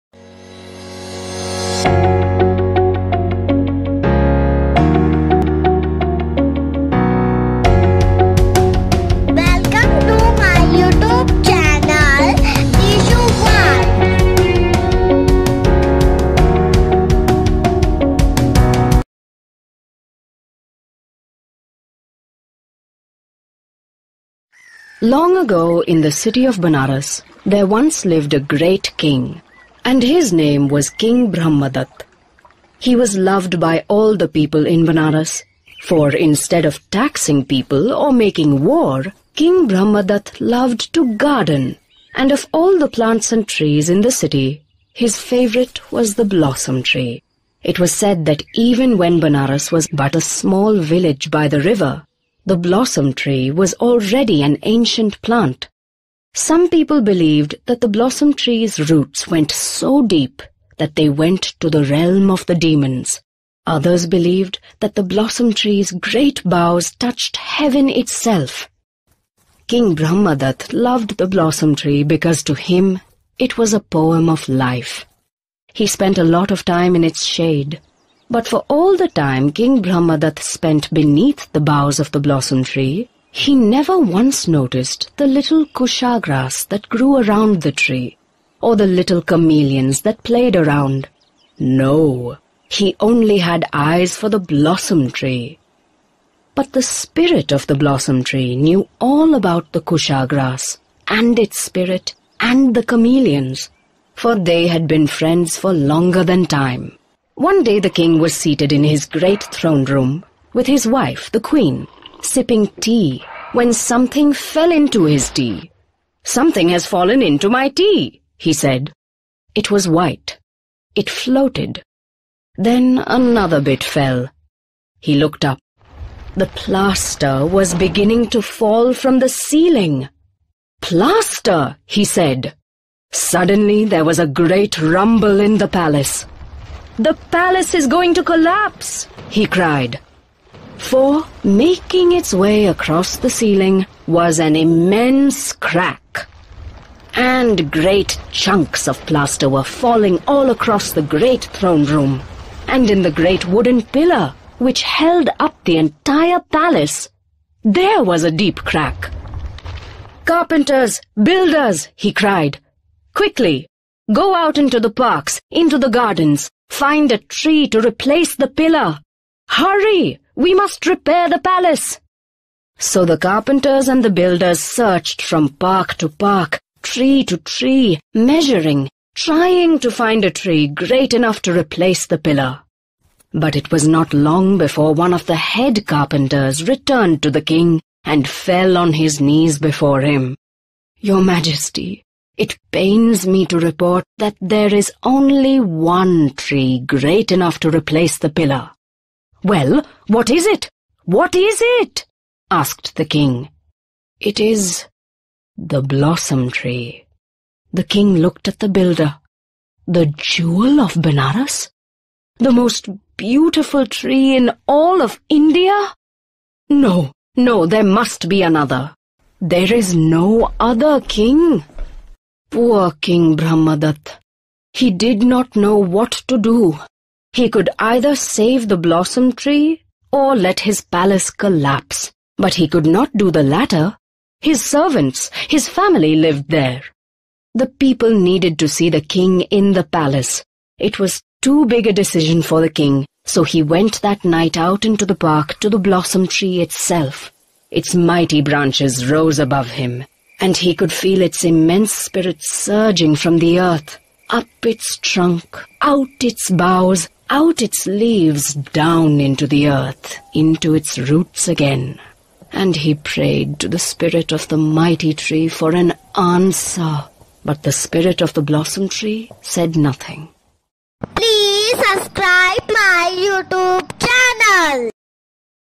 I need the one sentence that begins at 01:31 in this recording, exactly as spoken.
No, he only had eyes for the blossom tree.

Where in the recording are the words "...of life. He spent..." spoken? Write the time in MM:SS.
01:14.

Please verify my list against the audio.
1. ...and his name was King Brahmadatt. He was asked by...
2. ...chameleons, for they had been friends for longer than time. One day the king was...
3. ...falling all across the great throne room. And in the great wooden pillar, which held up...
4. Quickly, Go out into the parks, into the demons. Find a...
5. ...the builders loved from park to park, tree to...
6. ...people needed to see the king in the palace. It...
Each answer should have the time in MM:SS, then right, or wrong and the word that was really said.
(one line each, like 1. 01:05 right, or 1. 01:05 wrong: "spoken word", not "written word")
1. 00:29 wrong: "loved", not "asked"
2. 01:42 right
3. 02:29 right
4. 02:43 wrong: "gardens", not "demons"
5. 02:54 wrong: "searched", not "loved"
6. 03:57 right.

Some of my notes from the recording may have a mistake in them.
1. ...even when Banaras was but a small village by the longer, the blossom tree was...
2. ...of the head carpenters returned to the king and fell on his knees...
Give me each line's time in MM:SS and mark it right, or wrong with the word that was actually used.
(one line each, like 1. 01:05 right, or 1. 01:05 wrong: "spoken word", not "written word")
1. 00:48 wrong: "river", not "longer"
2. 03:05 right.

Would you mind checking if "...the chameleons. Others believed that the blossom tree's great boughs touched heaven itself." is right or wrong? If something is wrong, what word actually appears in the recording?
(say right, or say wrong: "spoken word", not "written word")
wrong: "demons", not "chameleons".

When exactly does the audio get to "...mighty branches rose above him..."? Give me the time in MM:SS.
04:07.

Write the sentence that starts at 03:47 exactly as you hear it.
He could either save the blossom tree or let his palace collapse, but he could not do the latter.